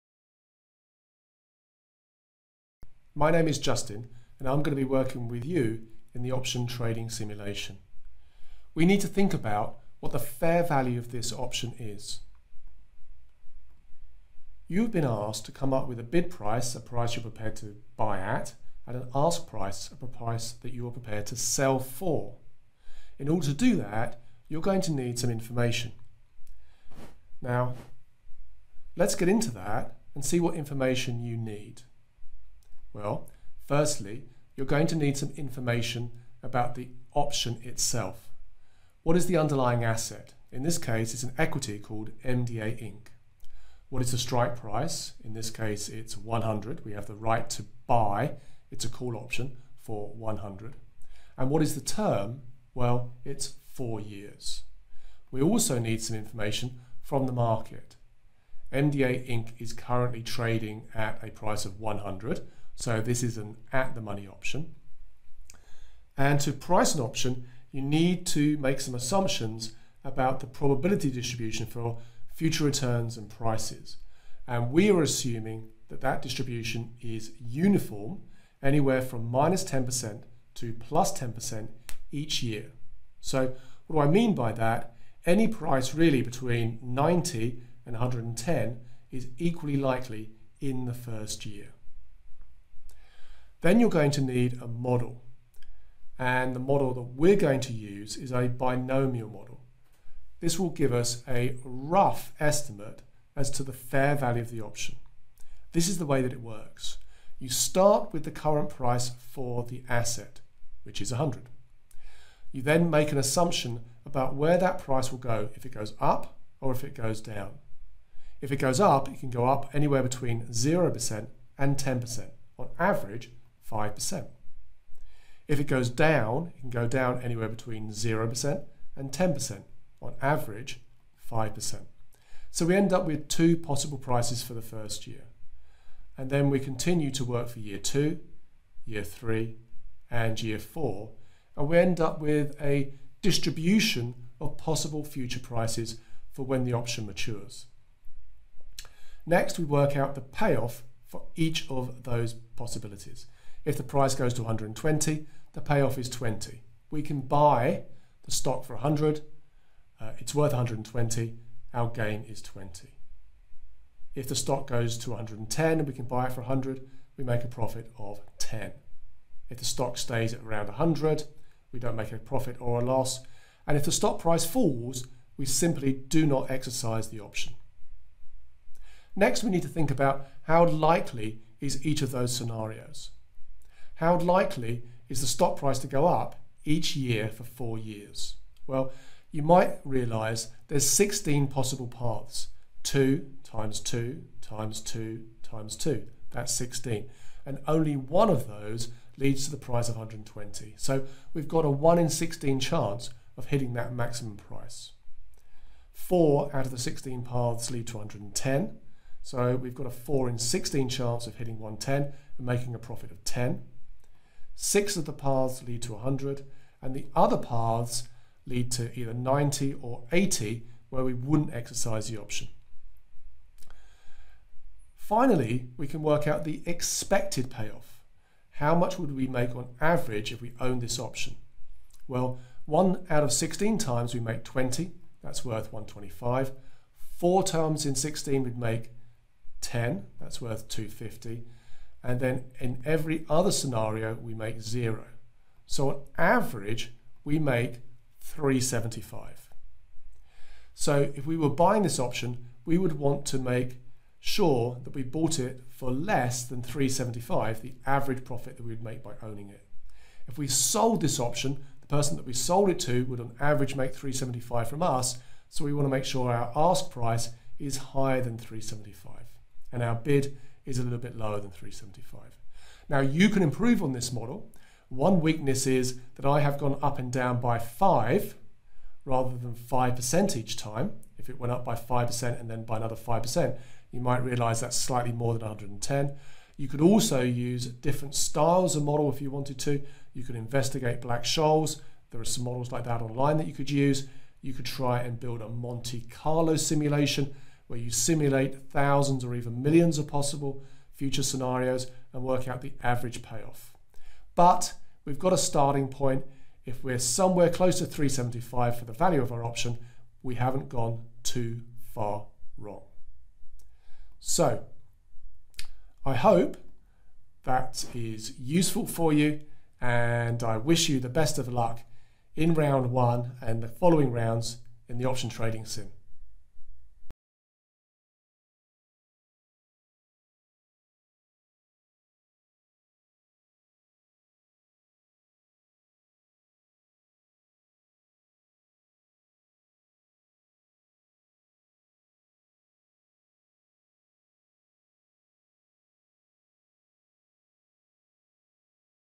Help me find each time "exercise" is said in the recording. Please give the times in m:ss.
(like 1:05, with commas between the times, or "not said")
2:56, 3:41.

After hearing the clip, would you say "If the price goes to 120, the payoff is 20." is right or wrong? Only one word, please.
right.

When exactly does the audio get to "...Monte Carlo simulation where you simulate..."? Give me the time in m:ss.
4:55.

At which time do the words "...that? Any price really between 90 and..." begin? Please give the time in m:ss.
1:24.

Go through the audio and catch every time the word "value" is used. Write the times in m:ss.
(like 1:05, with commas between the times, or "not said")
0:10, 1:44, 5:08.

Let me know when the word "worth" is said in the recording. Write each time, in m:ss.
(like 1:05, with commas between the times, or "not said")
2:40, 3:55, 4:00.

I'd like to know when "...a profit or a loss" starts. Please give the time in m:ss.
2:52.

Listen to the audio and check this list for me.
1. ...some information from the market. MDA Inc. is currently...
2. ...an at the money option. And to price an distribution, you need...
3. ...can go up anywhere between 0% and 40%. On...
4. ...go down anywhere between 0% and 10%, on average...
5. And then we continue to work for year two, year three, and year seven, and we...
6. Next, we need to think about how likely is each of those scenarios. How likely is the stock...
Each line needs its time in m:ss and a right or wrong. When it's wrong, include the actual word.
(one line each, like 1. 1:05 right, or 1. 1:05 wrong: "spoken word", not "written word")
1. 0:56 right
2. 1:03 wrong: "option", not "distribution"
3. 1:59 wrong: "10", not "40"
4. 2:06 right
5. 2:16 wrong: "four", not "seven"
6. 2:59 right.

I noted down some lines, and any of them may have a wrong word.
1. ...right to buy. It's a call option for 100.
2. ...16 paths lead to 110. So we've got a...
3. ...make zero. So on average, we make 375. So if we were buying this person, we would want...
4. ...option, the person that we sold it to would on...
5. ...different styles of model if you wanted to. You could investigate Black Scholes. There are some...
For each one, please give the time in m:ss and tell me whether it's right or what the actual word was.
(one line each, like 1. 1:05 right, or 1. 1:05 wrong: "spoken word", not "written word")
1. 0:47 right
2. 3:26 right
3. 4:04 wrong: "option", not "person"
4. 4:21 right
5. 4:47 right.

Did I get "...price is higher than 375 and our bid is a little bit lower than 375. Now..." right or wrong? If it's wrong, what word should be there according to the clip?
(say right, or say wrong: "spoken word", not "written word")
right.